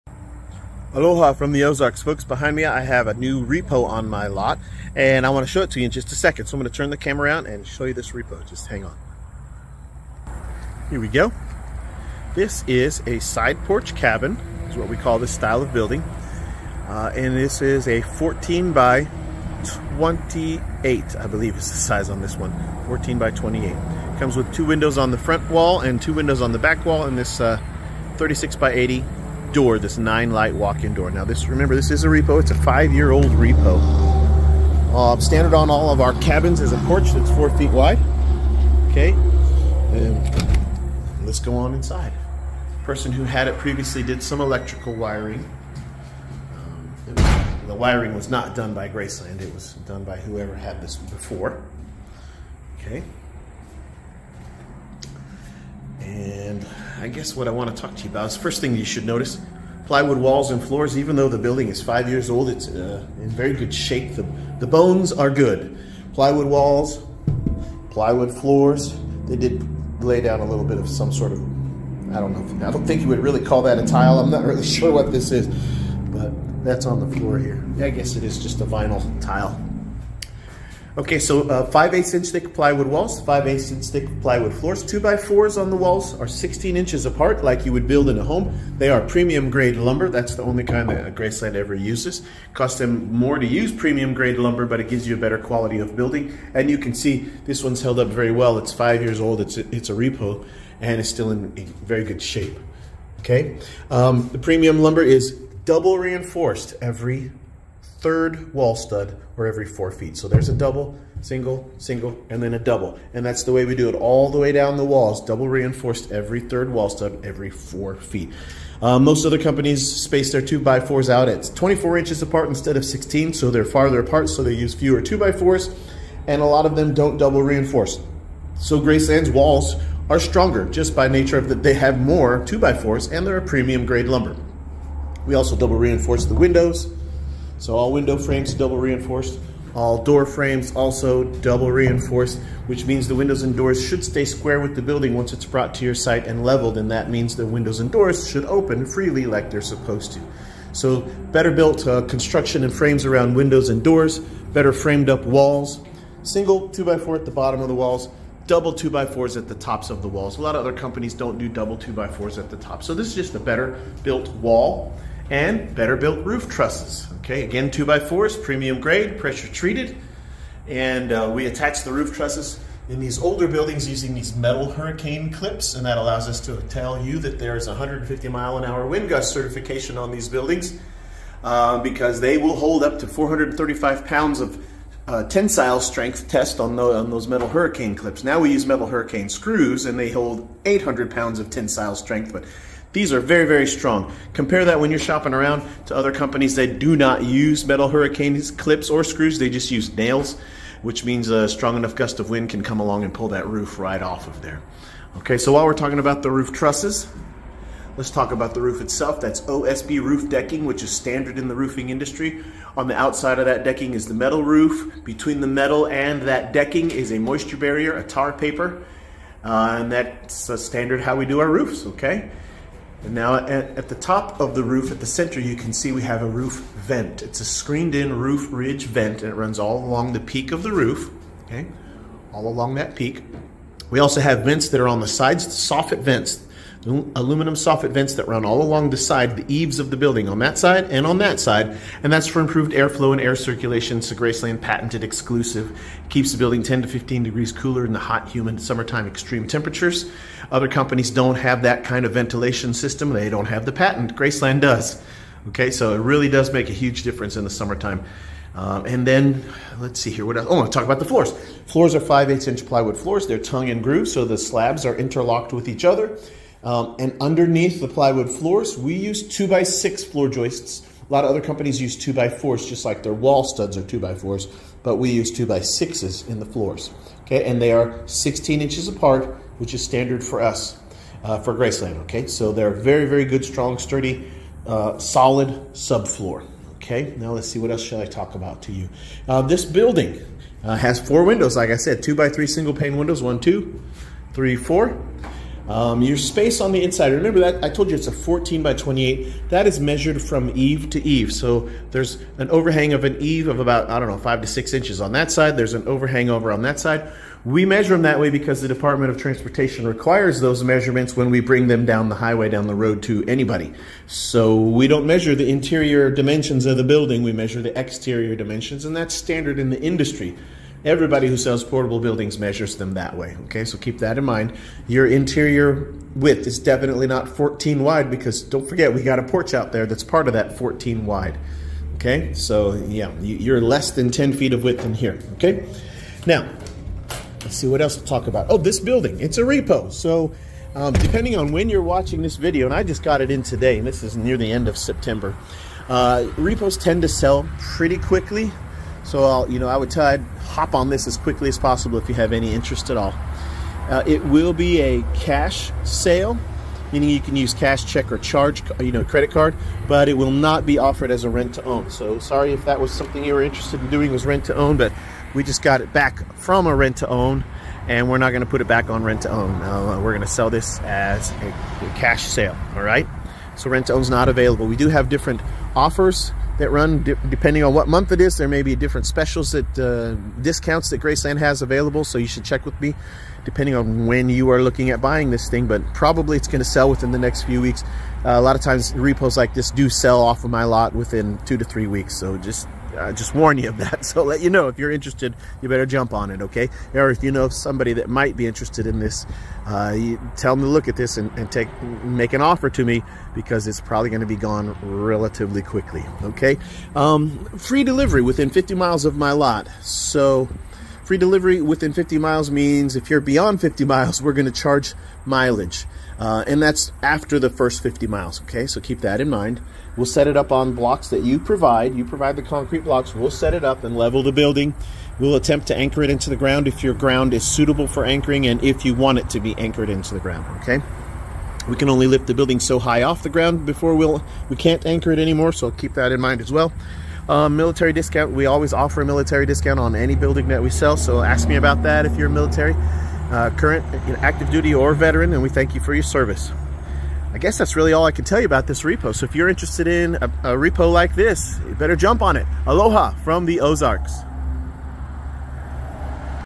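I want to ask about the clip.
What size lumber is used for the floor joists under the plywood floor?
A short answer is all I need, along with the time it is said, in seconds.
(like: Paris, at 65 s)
2 by 6, at 275 s.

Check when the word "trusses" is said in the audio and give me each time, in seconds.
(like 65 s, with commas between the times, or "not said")
166 s, 172 s, 206 s.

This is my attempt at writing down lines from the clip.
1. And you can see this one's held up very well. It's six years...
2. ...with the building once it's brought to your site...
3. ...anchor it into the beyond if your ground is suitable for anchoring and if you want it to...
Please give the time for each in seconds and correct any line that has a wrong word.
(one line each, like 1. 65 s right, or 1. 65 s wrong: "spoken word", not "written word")
1. 96 s wrong: "five", not "six"
2. 144 s right
3. 425 s wrong: "ground", not "beyond".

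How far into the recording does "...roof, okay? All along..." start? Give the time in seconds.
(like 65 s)
230 s.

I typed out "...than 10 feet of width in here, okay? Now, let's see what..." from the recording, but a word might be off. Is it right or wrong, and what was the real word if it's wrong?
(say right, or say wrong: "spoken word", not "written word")
right.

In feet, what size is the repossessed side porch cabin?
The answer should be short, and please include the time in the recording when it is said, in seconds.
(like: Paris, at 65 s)
14 by 28, at 22 s.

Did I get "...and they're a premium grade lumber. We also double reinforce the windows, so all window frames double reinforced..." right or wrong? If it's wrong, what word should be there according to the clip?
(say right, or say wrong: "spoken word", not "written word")
right.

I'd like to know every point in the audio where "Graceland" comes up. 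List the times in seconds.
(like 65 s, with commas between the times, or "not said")
48 s, 91 s, 128 s, 244 s, 254 s, 281 s, 381 s.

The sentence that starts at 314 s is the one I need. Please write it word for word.
So we don't measure the interior dimensions of the building.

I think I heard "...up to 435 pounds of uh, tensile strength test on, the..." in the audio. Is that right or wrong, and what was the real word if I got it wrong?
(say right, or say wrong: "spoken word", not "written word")
right.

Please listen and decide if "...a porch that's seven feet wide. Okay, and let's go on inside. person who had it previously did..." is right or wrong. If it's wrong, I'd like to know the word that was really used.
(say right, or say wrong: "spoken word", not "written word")
wrong: "four", not "seven".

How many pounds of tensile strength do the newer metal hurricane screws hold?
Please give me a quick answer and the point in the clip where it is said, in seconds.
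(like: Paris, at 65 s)
800 pounds, at 190 s.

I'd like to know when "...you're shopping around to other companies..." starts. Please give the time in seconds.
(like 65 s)
194 s.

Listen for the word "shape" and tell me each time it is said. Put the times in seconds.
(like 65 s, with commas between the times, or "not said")
63 s, 102 s.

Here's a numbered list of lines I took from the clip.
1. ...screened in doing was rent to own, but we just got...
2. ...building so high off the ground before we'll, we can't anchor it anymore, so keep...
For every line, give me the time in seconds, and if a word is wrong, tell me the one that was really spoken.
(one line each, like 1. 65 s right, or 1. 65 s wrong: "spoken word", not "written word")
1. 363 s wrong: "interested", not "screened"
2. 432 s right.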